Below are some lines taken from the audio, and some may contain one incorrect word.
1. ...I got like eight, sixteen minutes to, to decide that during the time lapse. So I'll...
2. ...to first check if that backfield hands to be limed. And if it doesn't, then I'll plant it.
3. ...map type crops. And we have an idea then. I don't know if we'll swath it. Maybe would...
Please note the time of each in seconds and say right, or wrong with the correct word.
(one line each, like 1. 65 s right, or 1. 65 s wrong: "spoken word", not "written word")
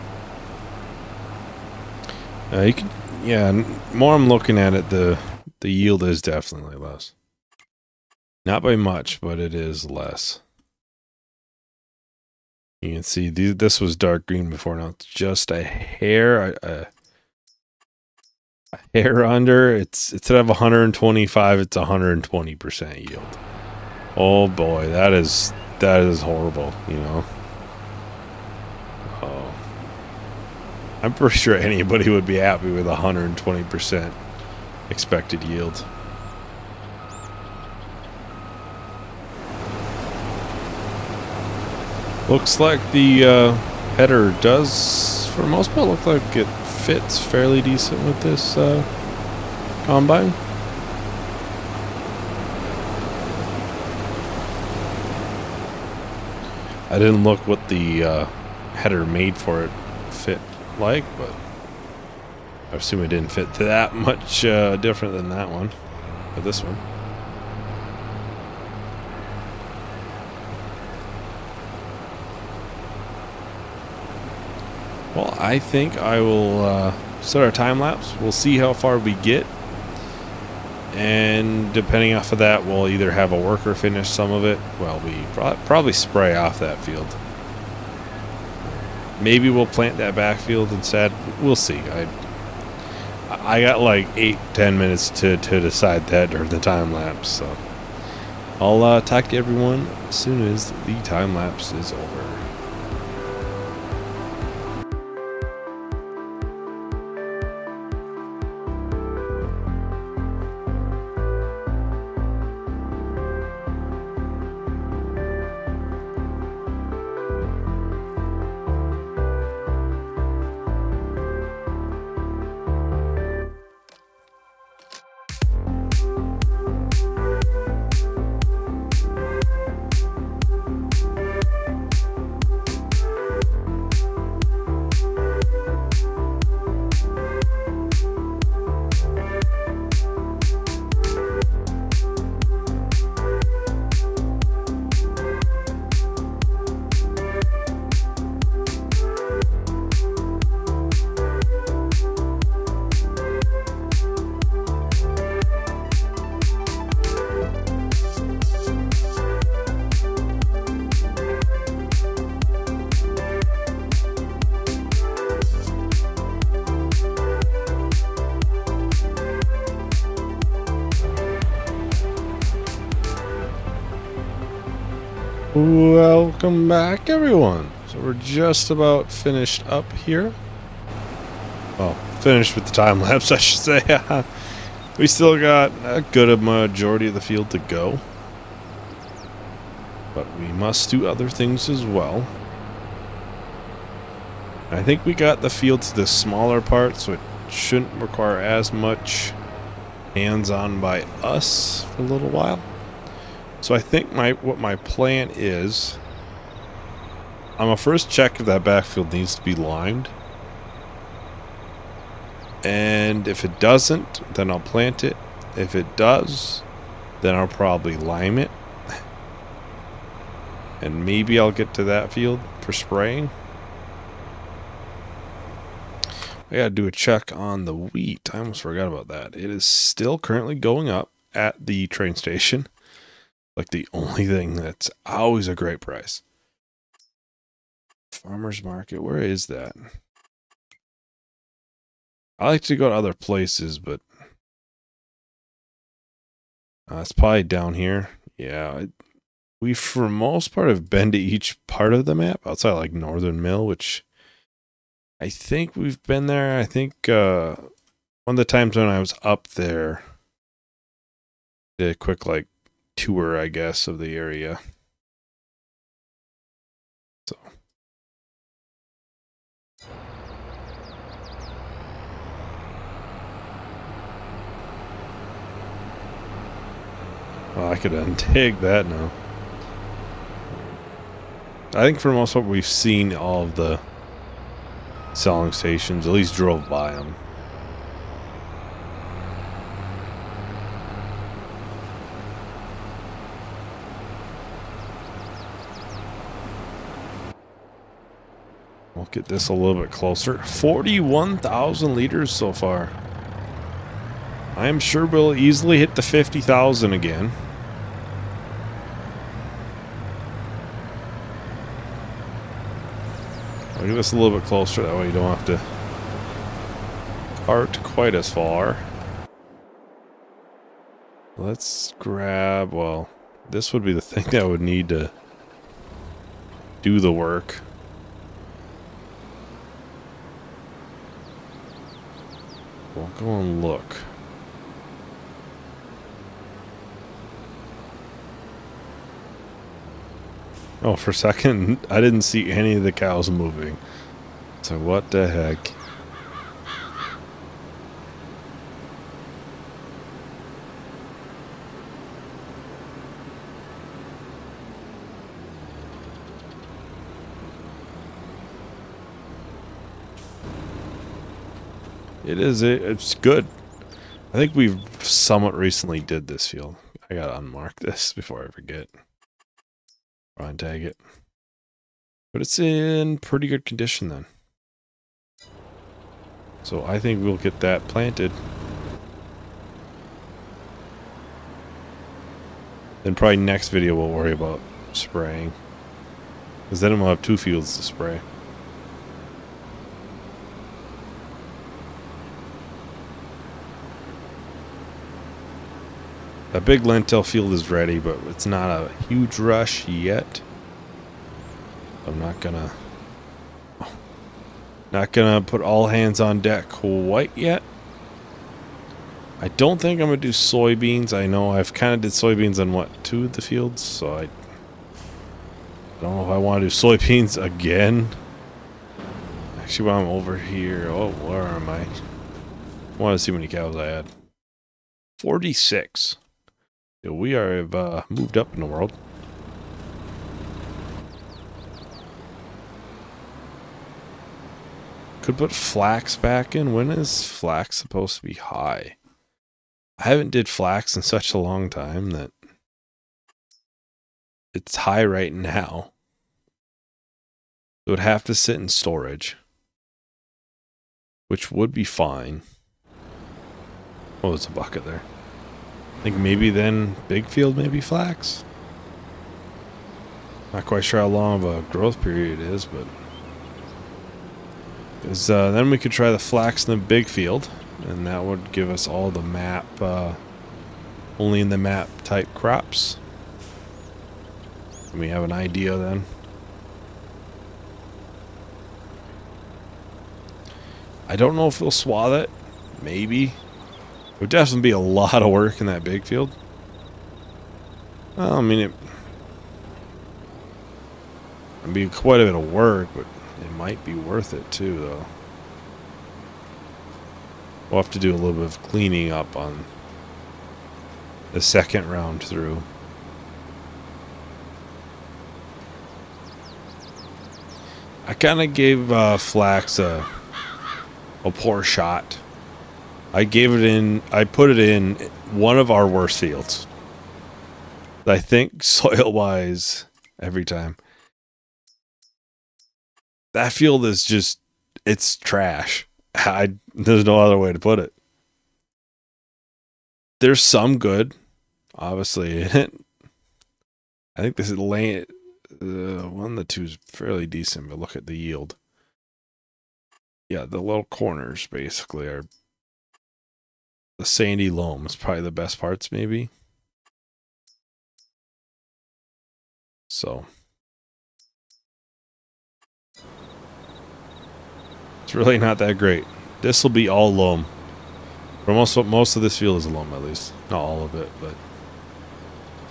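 1. 93 s wrong: "ten", not "sixteen"
2. 207 s wrong: "needs", not "hands"
3. 471 s right.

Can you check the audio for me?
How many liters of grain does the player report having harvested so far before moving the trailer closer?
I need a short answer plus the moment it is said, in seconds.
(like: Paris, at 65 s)
41,000 liters, at 300 s.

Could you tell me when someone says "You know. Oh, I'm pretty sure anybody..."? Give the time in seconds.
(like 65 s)
26 s.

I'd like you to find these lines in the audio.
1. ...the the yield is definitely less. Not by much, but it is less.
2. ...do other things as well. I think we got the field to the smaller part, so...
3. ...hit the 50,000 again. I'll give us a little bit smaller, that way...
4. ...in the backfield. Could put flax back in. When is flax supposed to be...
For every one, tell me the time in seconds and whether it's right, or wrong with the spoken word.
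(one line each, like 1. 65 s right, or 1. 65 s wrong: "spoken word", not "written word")
1. 4 s right
2. 190 s right
3. 305 s wrong: "closer", not "smaller"
4. 428 s wrong: "world", not "backfield".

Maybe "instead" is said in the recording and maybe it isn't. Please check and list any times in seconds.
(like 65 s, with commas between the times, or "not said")
20 s, 90 s.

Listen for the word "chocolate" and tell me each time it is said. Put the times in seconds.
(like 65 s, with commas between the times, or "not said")
not said.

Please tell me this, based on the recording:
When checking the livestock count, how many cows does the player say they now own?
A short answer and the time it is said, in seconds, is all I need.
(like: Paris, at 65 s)
46, at 425 s.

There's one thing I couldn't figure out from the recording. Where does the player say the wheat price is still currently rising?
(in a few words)
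train station.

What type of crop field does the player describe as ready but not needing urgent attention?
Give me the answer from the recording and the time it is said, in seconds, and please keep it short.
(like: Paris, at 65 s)
lentil field, at 396 s.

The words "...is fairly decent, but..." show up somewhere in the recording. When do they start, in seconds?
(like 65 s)
536 s.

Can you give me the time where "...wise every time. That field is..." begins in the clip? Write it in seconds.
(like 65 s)
519 s.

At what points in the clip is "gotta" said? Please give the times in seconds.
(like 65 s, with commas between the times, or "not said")
226 s, 367 s.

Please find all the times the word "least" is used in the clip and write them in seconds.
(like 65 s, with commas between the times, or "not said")
286 s, 560 s.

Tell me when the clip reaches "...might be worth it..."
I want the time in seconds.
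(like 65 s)
493 s.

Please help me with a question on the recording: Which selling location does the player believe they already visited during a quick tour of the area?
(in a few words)
Northern Mill.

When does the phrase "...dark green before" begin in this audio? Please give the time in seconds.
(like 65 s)
13 s.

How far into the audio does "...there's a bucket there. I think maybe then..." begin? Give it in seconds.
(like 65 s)
454 s.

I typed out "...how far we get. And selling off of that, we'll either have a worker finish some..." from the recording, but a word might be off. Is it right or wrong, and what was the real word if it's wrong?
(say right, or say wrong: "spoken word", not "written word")
wrong: "depending", not "selling".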